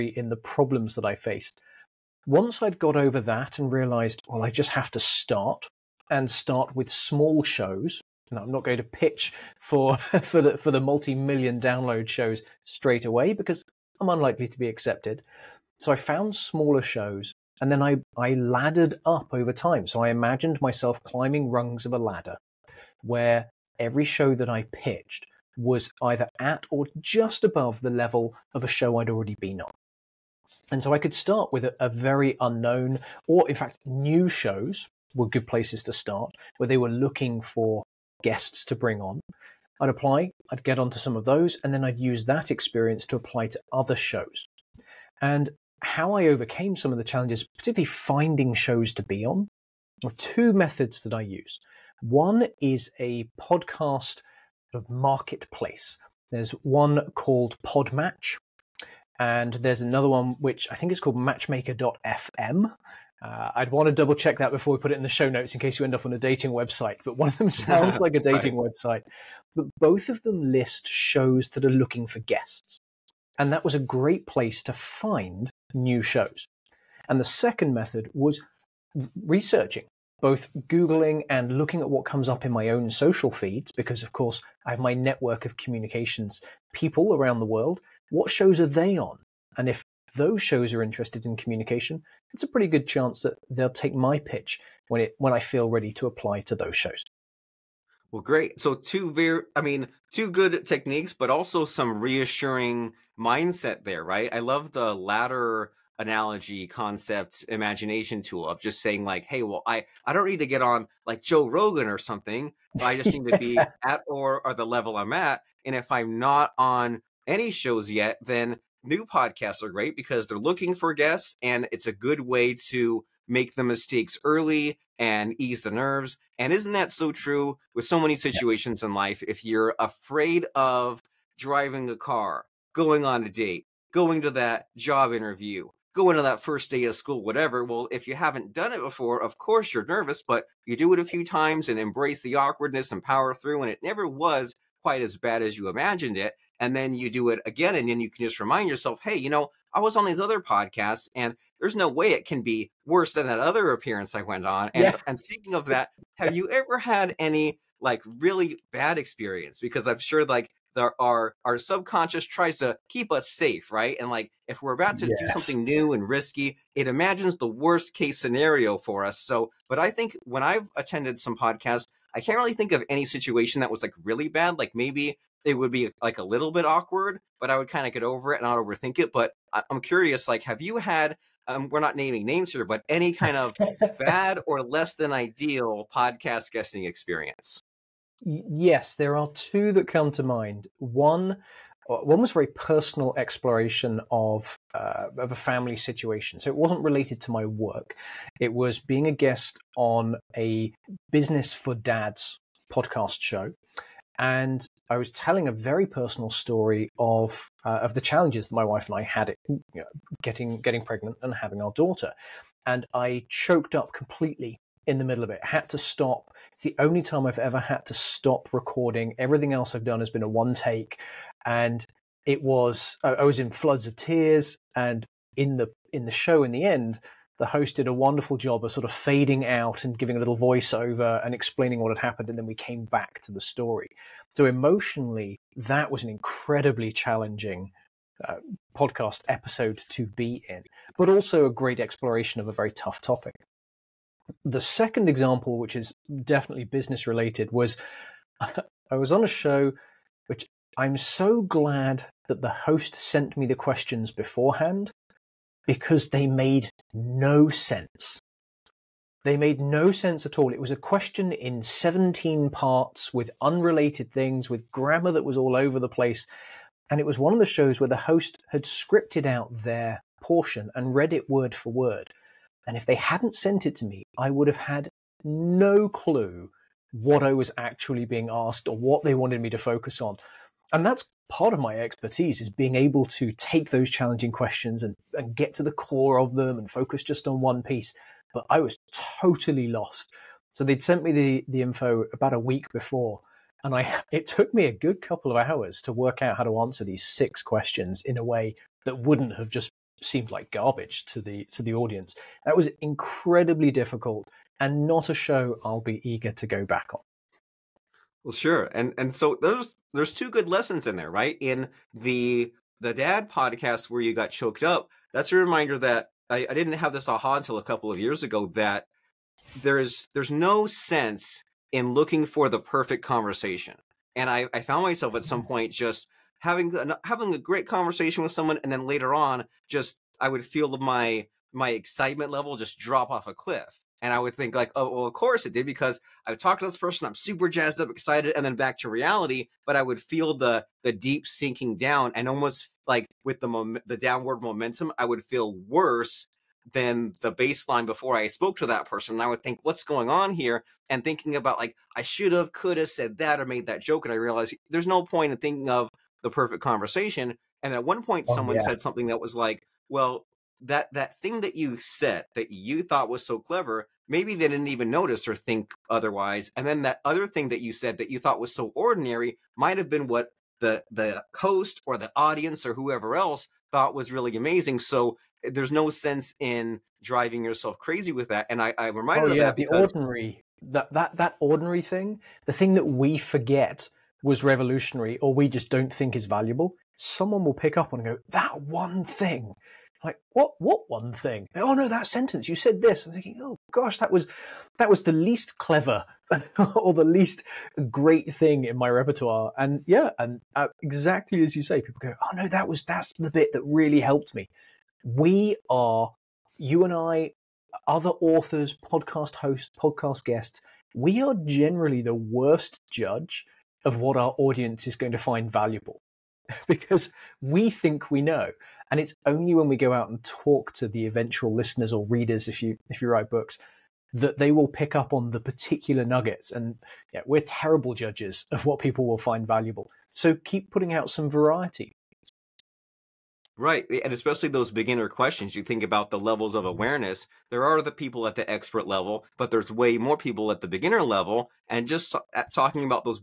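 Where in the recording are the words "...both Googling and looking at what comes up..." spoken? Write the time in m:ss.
1:20.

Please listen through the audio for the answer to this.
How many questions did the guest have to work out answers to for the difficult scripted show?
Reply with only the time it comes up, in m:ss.
4:57.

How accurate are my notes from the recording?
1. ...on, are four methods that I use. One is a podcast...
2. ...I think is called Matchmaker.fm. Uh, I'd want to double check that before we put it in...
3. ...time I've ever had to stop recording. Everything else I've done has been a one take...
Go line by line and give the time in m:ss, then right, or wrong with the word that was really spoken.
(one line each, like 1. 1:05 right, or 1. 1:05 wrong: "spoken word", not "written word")
1. 0:49 wrong: "two", not "four"
2. 1:00 right
3. 3:37 right.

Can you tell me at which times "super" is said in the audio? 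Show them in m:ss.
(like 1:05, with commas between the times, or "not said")
5:37.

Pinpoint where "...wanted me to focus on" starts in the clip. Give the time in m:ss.
4:39.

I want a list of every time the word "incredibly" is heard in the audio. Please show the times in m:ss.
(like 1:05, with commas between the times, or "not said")
3:56, 5:02.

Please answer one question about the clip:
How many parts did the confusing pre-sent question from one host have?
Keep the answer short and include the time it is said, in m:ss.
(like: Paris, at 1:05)
17, at 4:21.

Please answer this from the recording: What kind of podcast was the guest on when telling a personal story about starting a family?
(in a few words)
business for dads.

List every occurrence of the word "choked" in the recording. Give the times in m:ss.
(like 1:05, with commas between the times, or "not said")
3:33, 5:14.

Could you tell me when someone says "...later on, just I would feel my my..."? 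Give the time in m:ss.
5:28.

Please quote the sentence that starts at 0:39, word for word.
I'd apply, I'd get onto some of those, and then I'd use that experience to apply to other shows.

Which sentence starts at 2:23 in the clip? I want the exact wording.
And it never was quite as bad as you imagined it.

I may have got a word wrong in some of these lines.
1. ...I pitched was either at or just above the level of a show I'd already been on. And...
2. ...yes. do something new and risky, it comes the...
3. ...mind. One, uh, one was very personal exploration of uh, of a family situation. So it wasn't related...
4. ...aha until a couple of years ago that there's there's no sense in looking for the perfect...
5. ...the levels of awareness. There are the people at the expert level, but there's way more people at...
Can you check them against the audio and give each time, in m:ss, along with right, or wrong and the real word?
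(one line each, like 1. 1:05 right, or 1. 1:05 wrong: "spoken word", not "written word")
1. 0:24 right
2. 2:45 wrong: "imagines", not "comes"
3. 3:10 right
4. 5:17 right
5. 7:16 right.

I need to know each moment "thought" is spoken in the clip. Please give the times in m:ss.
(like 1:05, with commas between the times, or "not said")
6:02, 6:08, 6:13.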